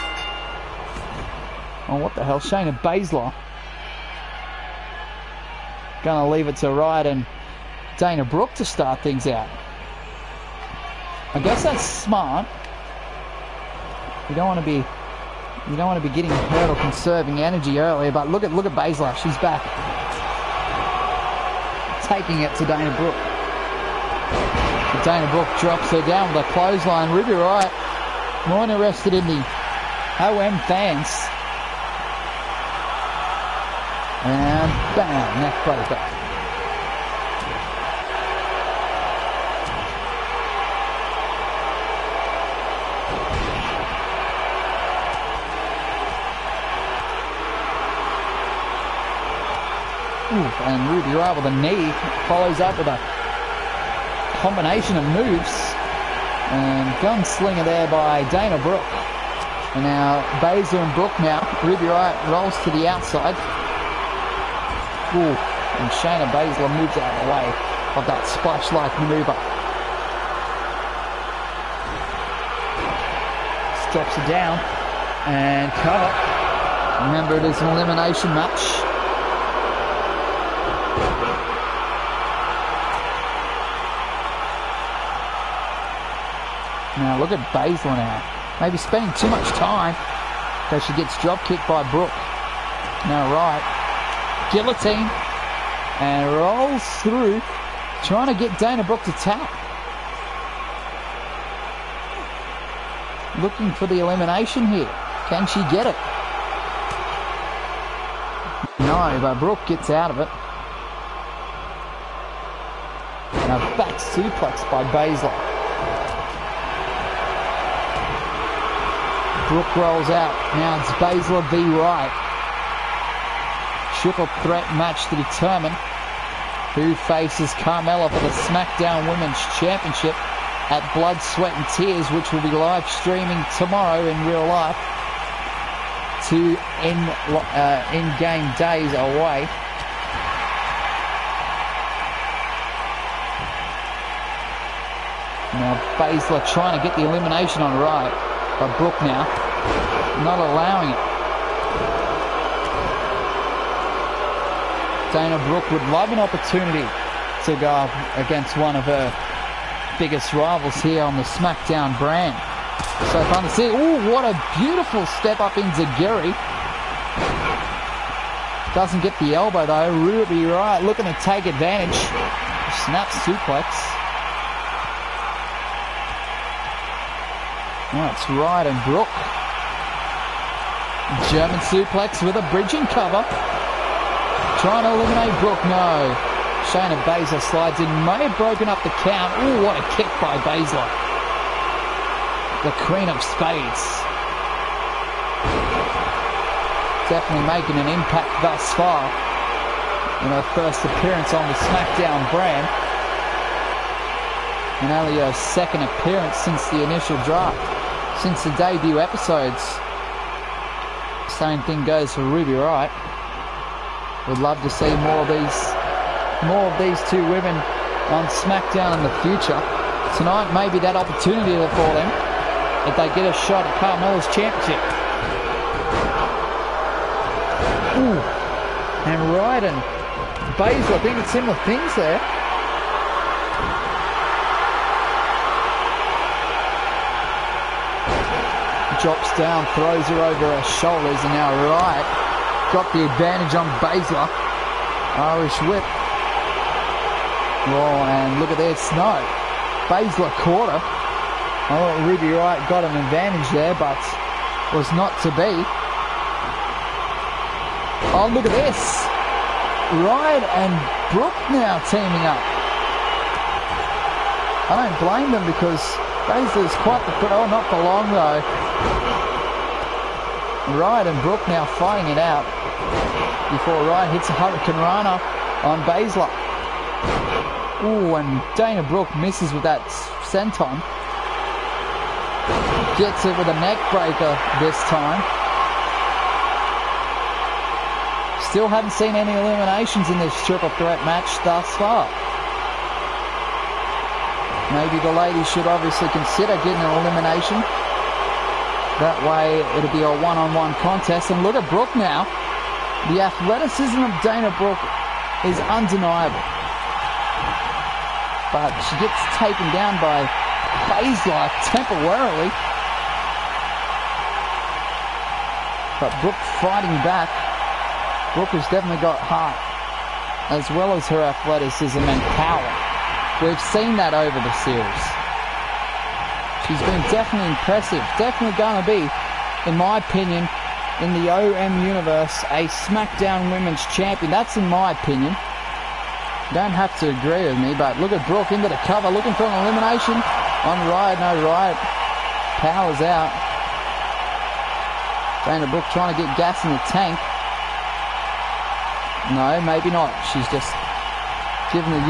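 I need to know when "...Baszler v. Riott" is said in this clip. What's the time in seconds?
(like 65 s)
121 s.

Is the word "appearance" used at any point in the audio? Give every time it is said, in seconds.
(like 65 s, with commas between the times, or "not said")
200 s, 205 s.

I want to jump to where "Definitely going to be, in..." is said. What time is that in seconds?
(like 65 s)
328 s.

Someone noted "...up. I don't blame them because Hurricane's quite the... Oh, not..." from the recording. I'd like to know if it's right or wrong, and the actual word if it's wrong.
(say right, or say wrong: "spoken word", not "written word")
wrong: "Baszler", not "Hurricane".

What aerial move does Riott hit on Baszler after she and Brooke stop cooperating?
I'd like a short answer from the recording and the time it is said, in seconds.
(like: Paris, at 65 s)
Hurricane Rana, at 274 s.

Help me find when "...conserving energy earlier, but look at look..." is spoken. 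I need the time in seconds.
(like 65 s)
16 s.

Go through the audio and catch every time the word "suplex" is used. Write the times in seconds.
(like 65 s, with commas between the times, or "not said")
113 s, 173 s, 181 s.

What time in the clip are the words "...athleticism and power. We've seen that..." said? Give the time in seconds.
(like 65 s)
321 s.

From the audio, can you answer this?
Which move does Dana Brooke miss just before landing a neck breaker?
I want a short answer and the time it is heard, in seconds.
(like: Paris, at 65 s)
senton, at 280 s.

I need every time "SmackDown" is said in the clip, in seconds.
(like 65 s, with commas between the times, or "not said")
128 s, 161 s, 201 s, 218 s, 332 s.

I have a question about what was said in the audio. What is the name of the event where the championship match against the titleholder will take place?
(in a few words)
Blood, Sweat and Tears.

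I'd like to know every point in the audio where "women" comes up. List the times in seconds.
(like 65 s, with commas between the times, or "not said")
129 s, 217 s, 333 s.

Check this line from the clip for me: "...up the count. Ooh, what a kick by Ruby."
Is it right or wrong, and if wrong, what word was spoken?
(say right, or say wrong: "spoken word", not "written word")
wrong: "Baszler", not "Ruby".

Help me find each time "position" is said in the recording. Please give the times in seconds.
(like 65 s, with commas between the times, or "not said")
not said.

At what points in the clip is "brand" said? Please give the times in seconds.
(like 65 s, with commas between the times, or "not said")
161 s, 202 s.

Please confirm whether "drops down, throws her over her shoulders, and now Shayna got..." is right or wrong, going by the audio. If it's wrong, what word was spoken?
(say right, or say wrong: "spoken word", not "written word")
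wrong: "Riott", not "Shayna".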